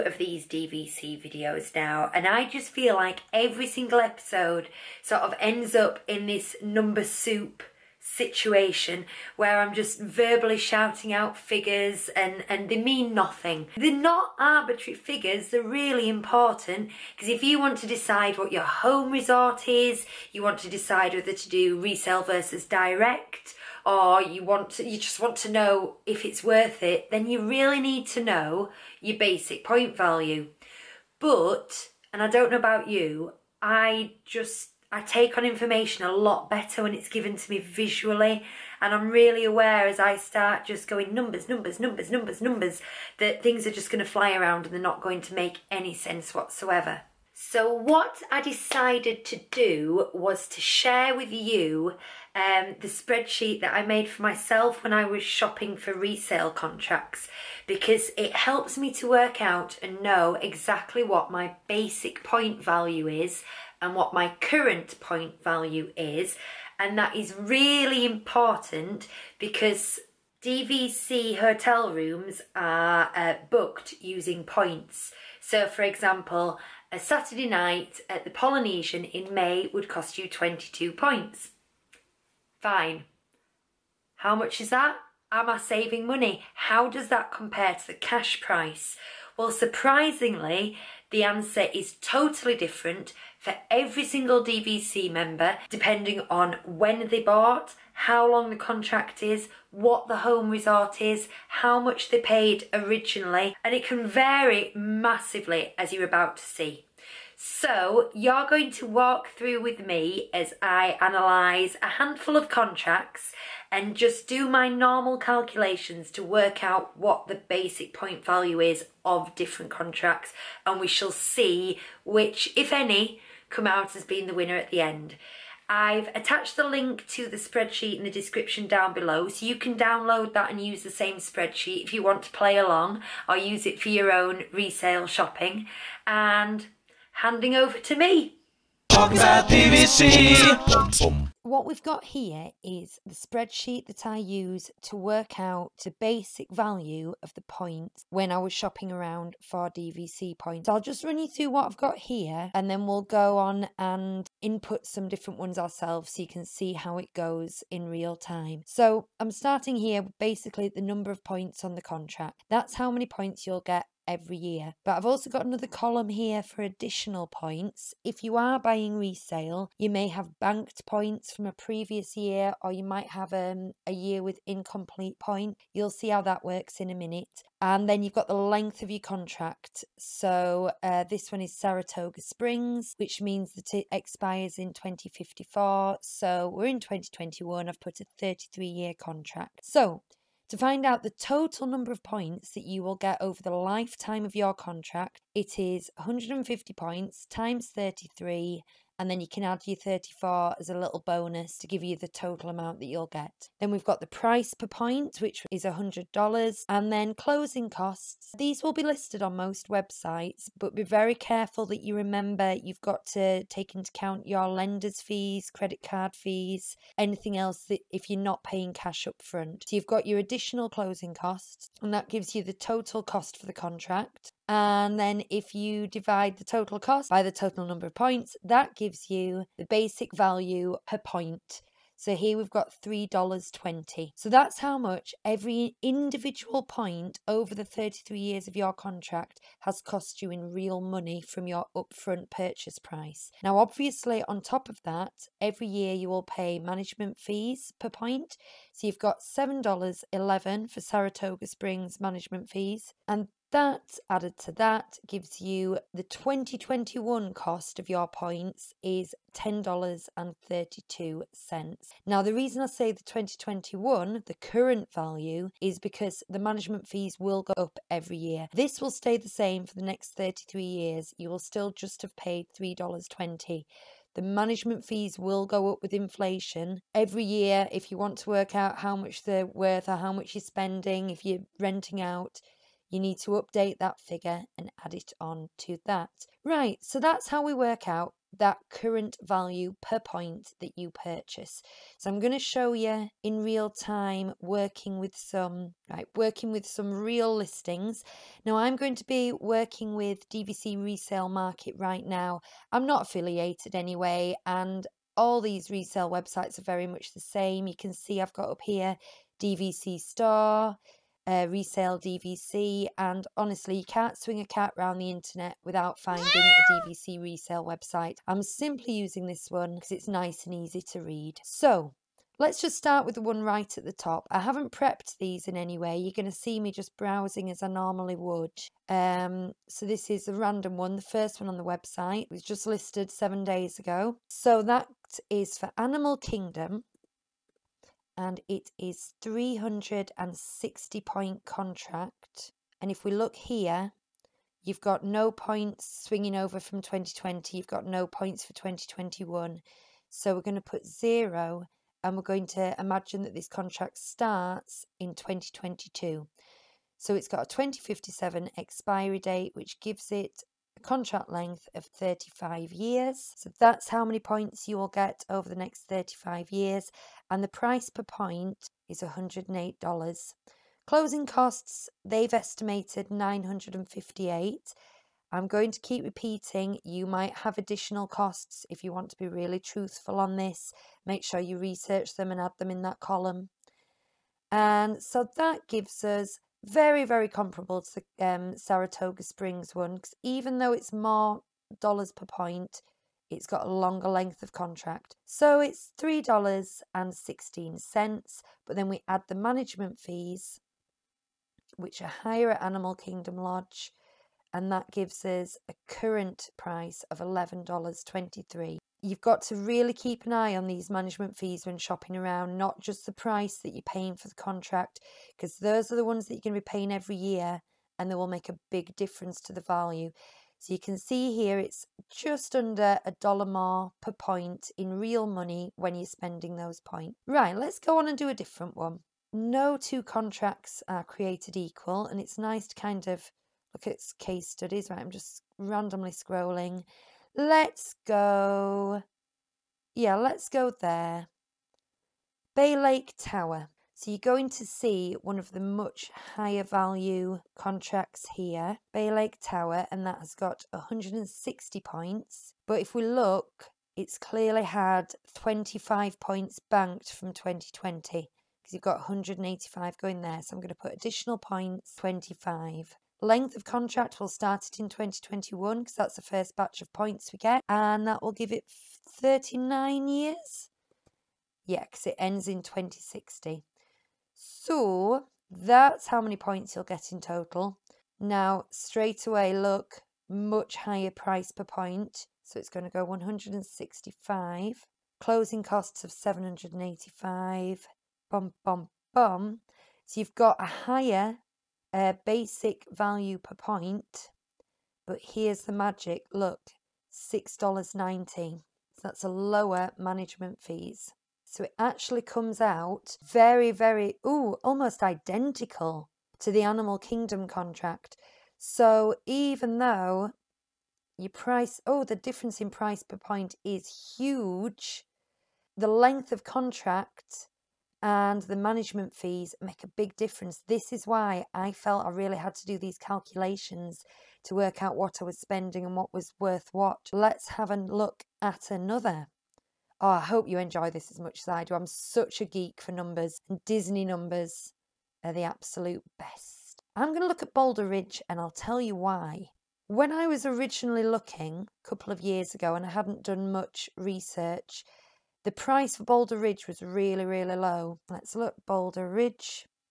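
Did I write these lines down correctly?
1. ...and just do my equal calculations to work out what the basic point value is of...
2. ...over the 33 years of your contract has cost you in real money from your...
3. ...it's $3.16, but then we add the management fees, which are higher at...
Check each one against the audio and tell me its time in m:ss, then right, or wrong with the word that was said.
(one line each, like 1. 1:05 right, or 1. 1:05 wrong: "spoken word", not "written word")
1. 1:53 wrong: "normal", not "equal"
2. 3:57 right
3. 6:35 right.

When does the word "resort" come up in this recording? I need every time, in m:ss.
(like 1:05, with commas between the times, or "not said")
0:19, 1:40.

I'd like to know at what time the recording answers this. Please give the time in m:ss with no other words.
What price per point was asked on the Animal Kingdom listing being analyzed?
6:09.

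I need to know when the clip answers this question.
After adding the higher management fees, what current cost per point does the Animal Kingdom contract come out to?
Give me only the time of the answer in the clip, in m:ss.
6:47.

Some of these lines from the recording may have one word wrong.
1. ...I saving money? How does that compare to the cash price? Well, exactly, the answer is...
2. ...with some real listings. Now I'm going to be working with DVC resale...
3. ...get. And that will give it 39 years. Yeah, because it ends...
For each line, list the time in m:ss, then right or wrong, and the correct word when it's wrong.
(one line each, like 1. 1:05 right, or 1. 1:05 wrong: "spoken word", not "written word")
1. 1:25 wrong: "surprisingly", not "exactly"
2. 4:56 right
3. 7:47 right.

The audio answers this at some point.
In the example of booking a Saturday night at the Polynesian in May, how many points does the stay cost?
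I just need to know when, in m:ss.
1:20.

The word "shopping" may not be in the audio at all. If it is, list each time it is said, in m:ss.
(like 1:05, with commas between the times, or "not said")
0:55, 2:15, 2:28, 6:51.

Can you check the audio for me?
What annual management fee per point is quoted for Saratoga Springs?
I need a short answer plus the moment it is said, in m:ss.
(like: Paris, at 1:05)
$7.11, at 4:09.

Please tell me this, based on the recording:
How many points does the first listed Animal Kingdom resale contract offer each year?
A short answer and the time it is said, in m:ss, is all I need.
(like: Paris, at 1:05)
360, at 5:39.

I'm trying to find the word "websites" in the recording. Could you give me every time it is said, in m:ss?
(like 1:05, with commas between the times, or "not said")
3:29, 5:06, 5:17, 5:31.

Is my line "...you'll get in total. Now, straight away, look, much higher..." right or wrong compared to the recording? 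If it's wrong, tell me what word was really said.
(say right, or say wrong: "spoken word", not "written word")
right.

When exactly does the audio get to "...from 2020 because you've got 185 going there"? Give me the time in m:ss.
7:37.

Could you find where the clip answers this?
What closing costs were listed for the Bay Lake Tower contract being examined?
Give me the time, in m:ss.
8:06.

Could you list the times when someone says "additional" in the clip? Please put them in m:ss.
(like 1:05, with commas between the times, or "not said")
2:46, 3:40, 6:17, 7:40.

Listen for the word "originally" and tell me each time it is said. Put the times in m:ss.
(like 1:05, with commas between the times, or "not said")
1:42, 9:00.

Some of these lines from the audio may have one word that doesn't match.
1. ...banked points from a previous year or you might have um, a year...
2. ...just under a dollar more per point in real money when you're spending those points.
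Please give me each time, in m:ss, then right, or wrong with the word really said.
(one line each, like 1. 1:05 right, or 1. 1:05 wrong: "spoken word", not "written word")
1. 2:50 right
2. 7:02 right.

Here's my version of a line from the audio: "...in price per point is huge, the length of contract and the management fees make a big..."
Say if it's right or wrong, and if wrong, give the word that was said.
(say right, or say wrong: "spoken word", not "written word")
right.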